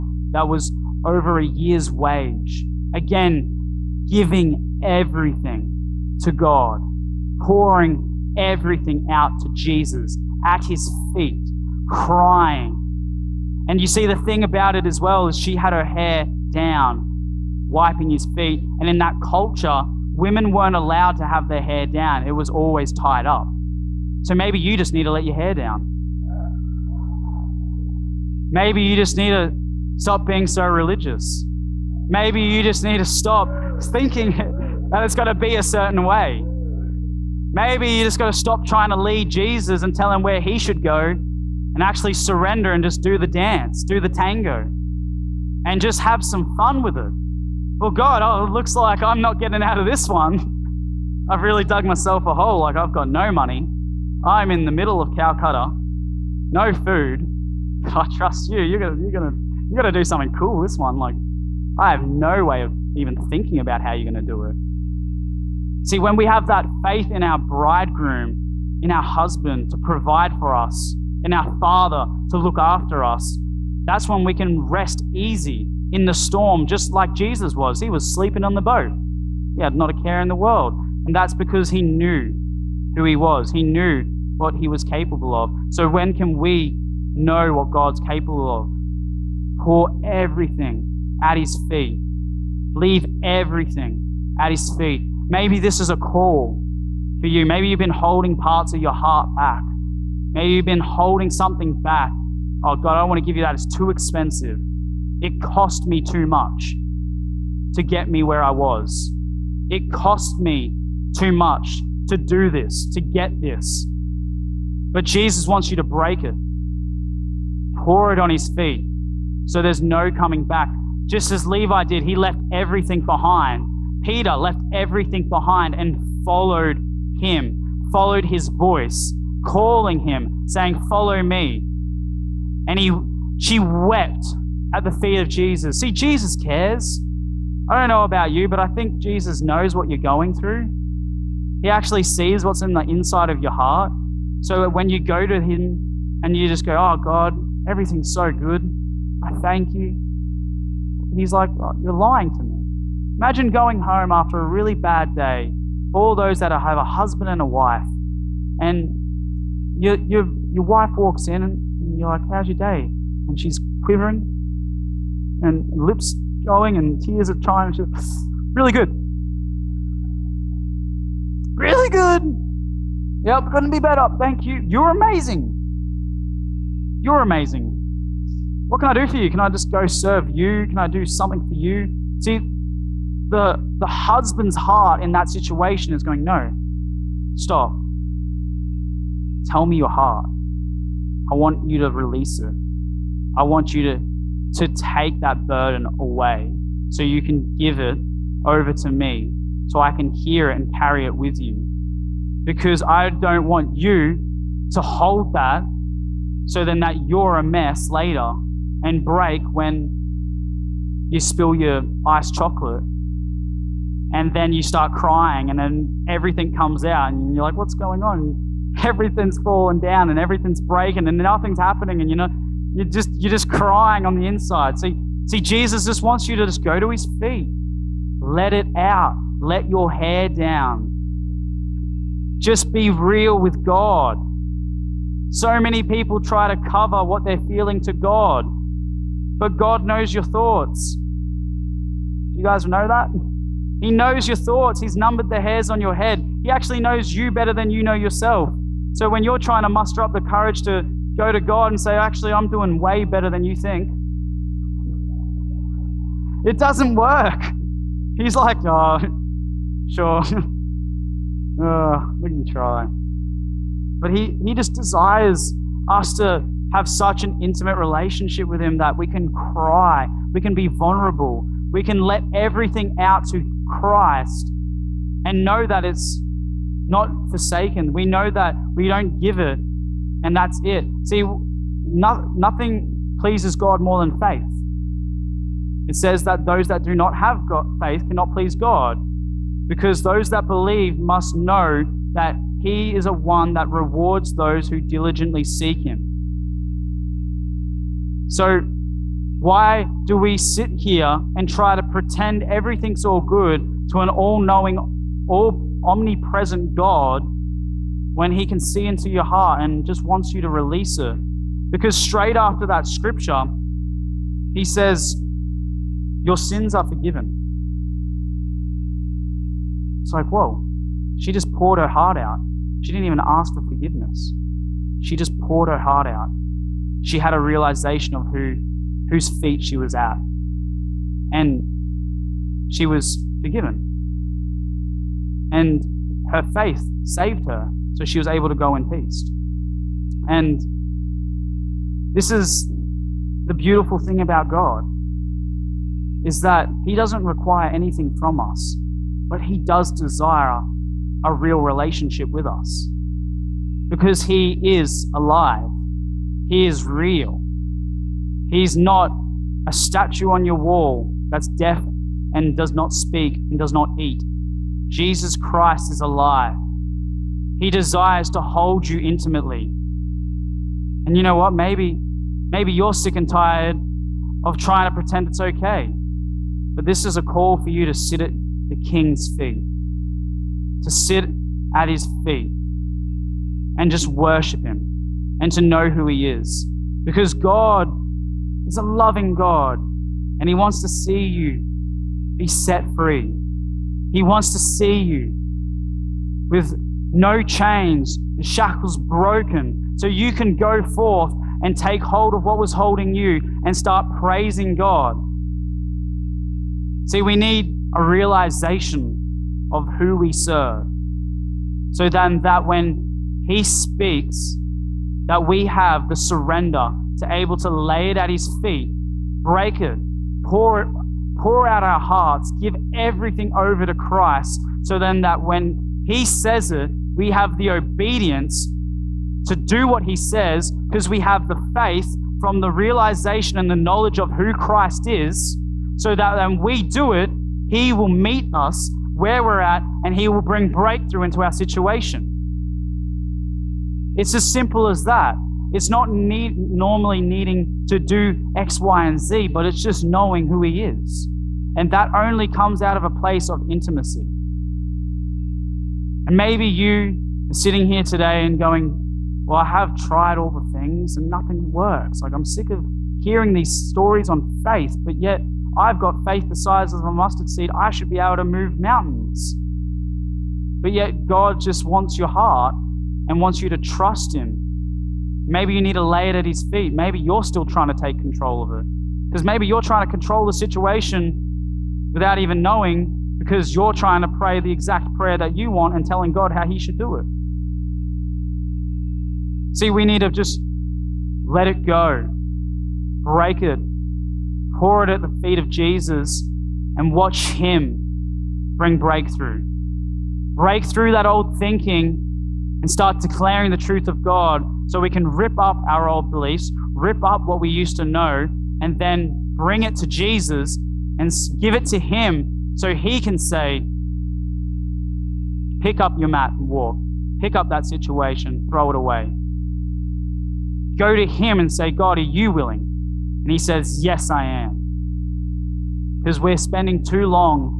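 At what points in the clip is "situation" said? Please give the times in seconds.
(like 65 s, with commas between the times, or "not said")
185 s, 441 s, 480 s, 517 s.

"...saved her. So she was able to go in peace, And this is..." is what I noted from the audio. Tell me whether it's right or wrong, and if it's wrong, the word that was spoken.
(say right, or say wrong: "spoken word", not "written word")
right.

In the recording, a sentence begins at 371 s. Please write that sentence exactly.
Maybe, maybe you're sick and tired of trying to pretend it's okay.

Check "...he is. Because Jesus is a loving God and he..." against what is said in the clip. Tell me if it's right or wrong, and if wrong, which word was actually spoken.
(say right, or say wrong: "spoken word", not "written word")
wrong: "God", not "Jesus".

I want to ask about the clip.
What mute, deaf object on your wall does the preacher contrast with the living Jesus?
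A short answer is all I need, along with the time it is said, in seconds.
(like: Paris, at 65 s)
a statue, at 359 s.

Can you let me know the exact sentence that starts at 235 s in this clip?
So many people try to cover what they're feeling to God, but God knows your thoughts.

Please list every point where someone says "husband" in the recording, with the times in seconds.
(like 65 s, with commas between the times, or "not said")
69 s, 156 s, 183 s.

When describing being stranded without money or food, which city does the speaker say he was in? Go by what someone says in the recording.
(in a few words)
Calcutta.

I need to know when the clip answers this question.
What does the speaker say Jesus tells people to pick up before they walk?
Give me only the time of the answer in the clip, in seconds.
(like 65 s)
516 s.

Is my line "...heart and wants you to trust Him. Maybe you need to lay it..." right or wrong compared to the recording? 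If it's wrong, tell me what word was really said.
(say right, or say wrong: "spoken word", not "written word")
right.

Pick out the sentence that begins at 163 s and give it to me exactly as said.
And she's quivering and lips going and tears are trying to really good.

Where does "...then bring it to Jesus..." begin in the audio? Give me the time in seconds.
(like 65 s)
508 s.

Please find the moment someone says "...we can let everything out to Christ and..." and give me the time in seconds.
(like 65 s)
271 s.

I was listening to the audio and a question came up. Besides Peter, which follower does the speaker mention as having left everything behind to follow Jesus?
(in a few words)
Levi.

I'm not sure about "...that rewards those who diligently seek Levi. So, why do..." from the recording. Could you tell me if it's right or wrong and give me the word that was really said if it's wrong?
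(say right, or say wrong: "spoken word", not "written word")
wrong: "Him", not "Levi".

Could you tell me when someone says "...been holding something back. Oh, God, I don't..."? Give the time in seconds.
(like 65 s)
100 s.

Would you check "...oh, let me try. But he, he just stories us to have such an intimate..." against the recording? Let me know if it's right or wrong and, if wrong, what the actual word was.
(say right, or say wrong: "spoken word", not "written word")
wrong: "desires", not "stories".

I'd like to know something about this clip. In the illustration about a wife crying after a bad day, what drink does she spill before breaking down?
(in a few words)
iced chocolate.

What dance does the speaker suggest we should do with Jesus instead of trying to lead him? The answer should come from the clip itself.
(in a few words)
the tango.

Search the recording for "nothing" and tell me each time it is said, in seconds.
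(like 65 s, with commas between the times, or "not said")
221 s, 282 s, 461 s.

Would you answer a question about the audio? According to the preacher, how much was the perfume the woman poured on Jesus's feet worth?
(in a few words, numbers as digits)
over a year's wage.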